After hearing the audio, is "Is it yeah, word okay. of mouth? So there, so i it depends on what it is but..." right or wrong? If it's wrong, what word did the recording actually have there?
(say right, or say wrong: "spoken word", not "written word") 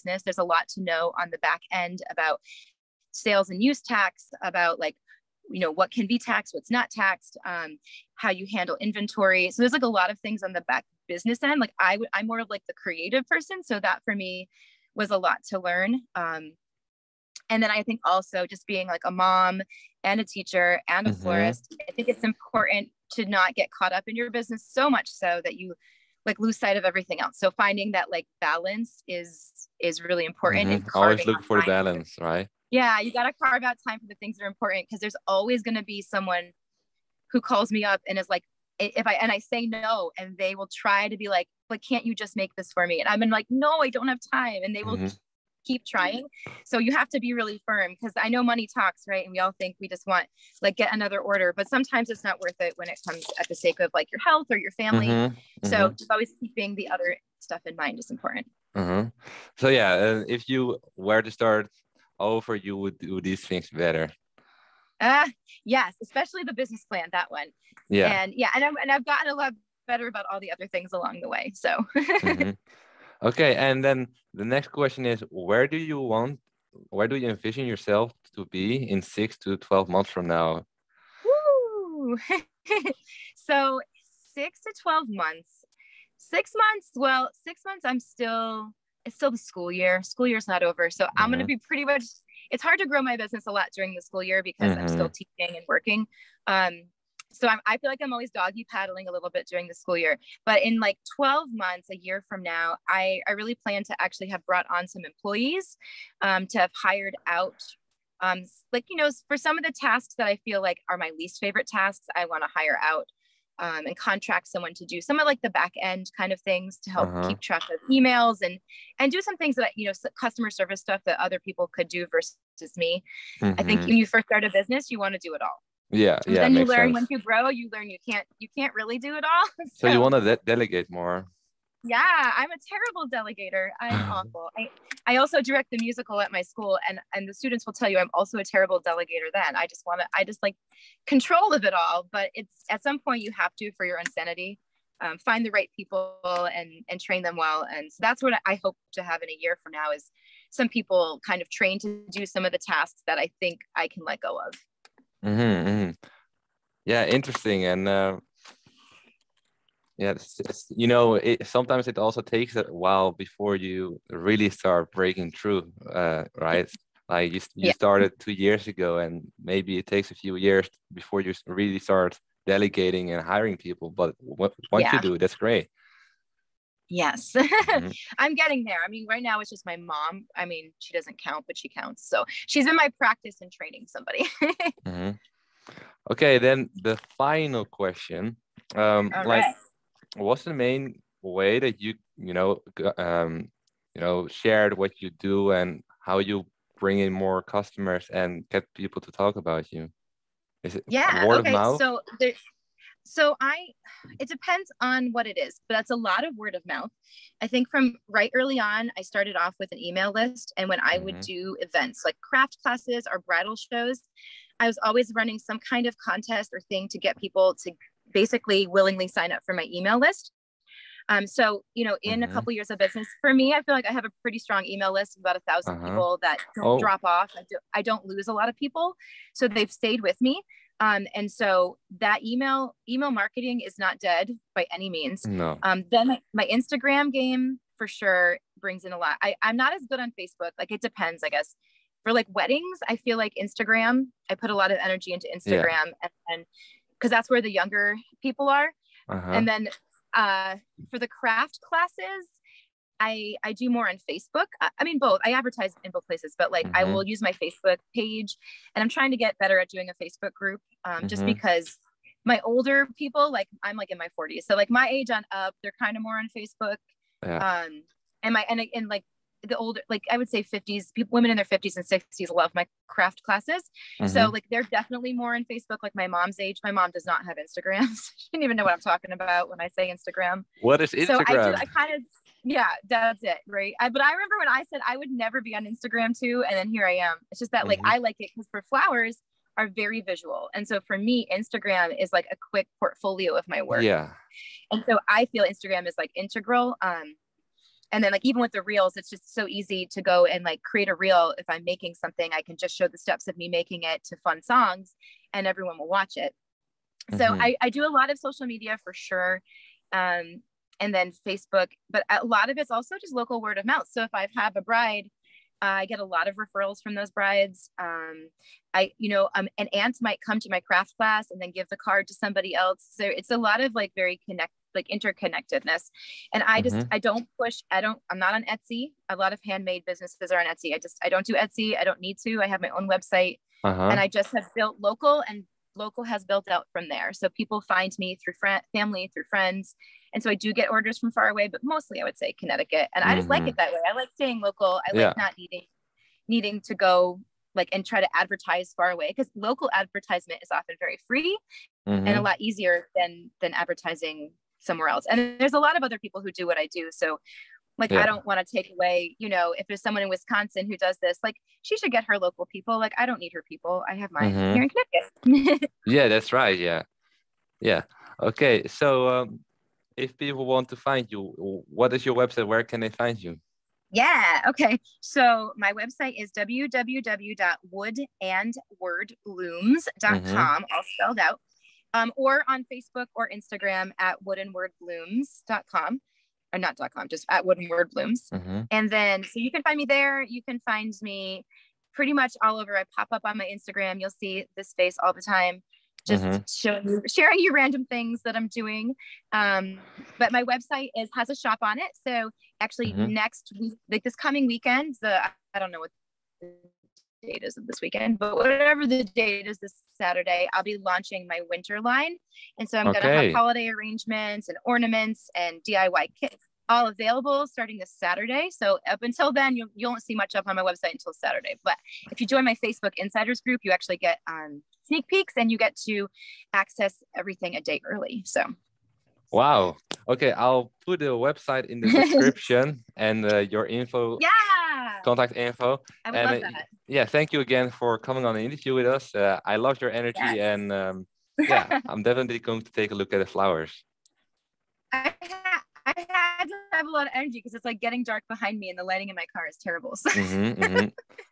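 right.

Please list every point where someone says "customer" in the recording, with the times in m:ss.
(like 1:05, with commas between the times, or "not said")
2:00, 3:17.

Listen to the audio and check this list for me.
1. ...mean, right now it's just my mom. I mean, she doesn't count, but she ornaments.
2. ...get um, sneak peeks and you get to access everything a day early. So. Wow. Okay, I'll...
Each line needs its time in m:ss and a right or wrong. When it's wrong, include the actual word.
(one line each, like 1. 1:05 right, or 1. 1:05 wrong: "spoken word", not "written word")
1. 2:58 wrong: "counts", not "ornaments"
2. 7:03 right.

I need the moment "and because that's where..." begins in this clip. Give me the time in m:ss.
4:06.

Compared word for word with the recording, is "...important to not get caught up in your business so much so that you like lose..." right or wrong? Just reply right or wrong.
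right.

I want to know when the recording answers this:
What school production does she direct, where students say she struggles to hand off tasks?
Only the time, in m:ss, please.
2:15.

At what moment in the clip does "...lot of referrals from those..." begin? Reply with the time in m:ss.
5:16.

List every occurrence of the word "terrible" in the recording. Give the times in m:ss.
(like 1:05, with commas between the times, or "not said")
2:12, 2:18, 7:29.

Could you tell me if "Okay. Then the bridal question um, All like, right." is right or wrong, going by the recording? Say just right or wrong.
wrong.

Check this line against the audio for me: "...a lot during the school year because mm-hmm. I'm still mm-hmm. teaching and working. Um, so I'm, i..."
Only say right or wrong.
right.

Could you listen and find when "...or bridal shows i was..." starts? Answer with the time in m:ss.
3:33.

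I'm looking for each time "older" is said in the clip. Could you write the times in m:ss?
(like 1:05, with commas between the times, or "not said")
4:22, 4:29.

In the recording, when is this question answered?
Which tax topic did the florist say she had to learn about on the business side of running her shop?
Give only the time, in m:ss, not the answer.
0:03.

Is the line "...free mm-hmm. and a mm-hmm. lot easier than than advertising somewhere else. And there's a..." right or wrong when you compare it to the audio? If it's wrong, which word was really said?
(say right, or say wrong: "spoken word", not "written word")
right.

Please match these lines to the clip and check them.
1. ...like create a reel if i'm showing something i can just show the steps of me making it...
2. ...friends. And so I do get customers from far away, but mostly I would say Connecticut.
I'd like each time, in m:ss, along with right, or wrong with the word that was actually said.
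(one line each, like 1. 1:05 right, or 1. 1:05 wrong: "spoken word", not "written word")
1. 5:00 wrong: "making", not "showing"
2. 5:39 wrong: "orders", not "customers".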